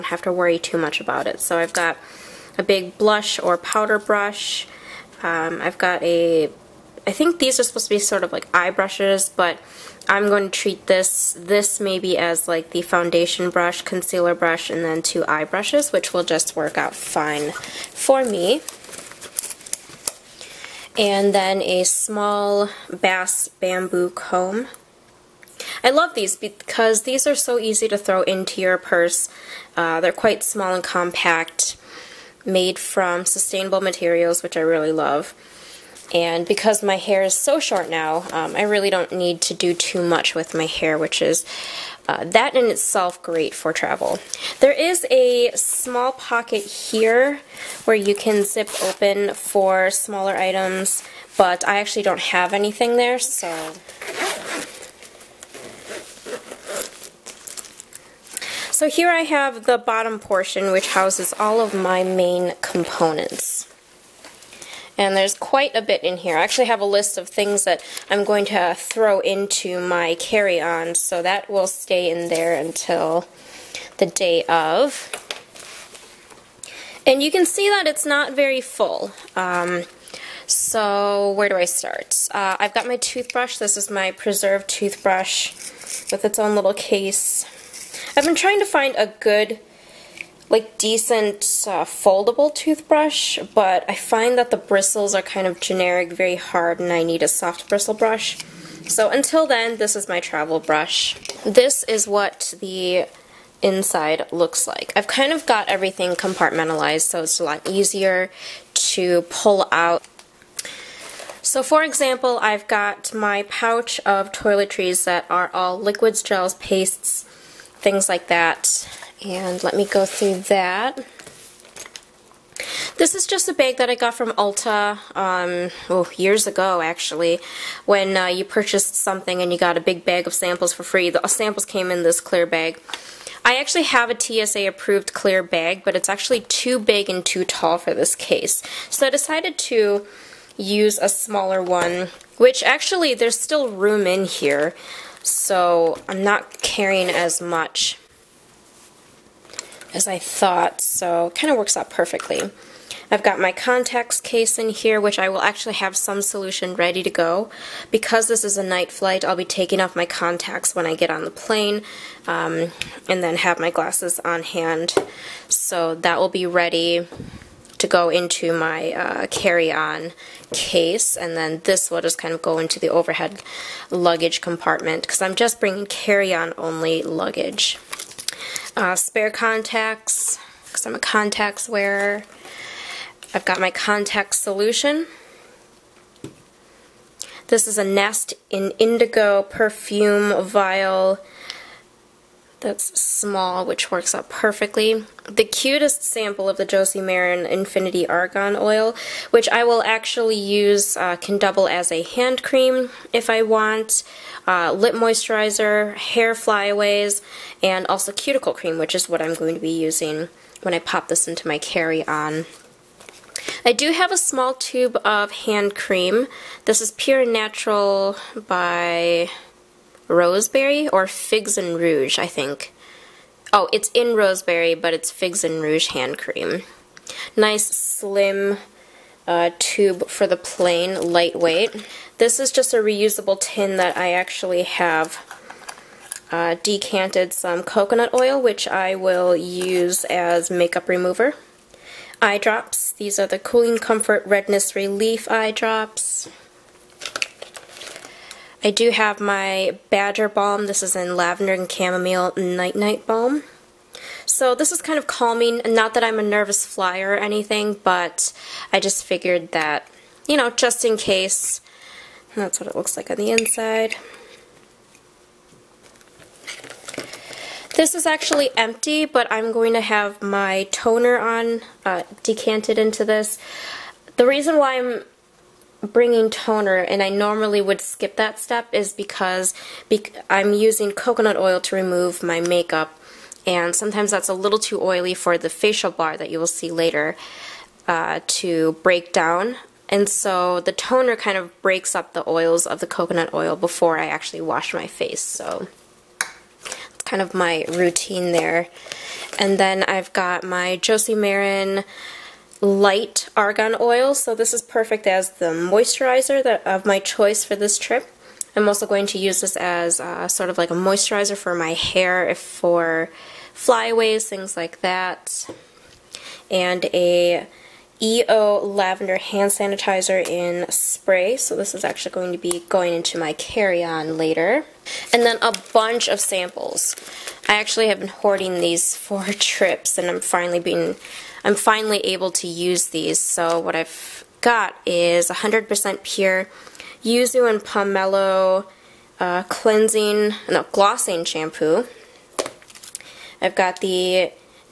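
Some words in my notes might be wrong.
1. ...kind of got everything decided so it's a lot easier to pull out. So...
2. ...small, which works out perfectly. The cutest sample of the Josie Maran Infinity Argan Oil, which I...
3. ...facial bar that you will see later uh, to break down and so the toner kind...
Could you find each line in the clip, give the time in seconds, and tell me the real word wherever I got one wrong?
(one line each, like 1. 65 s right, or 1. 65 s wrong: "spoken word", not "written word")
1. 105 s wrong: "compartmentalized", not "decided"
2. 193 s right
3. 285 s right.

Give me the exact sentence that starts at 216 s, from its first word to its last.
This is Pure Natural by Roseberry or Figs and Rouge, I think.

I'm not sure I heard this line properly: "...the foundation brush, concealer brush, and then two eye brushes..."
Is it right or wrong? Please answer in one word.
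right.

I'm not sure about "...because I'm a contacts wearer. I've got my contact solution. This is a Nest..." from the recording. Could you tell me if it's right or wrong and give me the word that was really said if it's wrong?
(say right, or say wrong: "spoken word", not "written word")
right.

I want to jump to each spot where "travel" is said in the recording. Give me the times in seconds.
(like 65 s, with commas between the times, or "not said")
43 s, 100 s.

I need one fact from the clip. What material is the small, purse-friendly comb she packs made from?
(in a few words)
Bamboo.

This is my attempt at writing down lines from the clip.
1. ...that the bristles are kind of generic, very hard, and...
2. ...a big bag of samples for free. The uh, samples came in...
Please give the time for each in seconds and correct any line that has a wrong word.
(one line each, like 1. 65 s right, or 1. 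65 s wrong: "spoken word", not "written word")
1. 94 s right
2. 129 s right.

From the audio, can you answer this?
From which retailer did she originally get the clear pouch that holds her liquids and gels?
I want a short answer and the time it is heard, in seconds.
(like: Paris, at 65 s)
Ulta, at 124 s.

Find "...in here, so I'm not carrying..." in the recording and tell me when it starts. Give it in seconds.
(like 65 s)
144 s.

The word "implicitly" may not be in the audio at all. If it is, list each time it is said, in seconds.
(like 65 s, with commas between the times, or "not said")
not said.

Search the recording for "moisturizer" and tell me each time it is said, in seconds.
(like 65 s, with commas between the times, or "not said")
204 s, 305 s, 310 s.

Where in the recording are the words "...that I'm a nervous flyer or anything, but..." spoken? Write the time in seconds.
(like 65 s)
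255 s.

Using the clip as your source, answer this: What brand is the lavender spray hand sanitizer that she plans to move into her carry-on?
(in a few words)
EO.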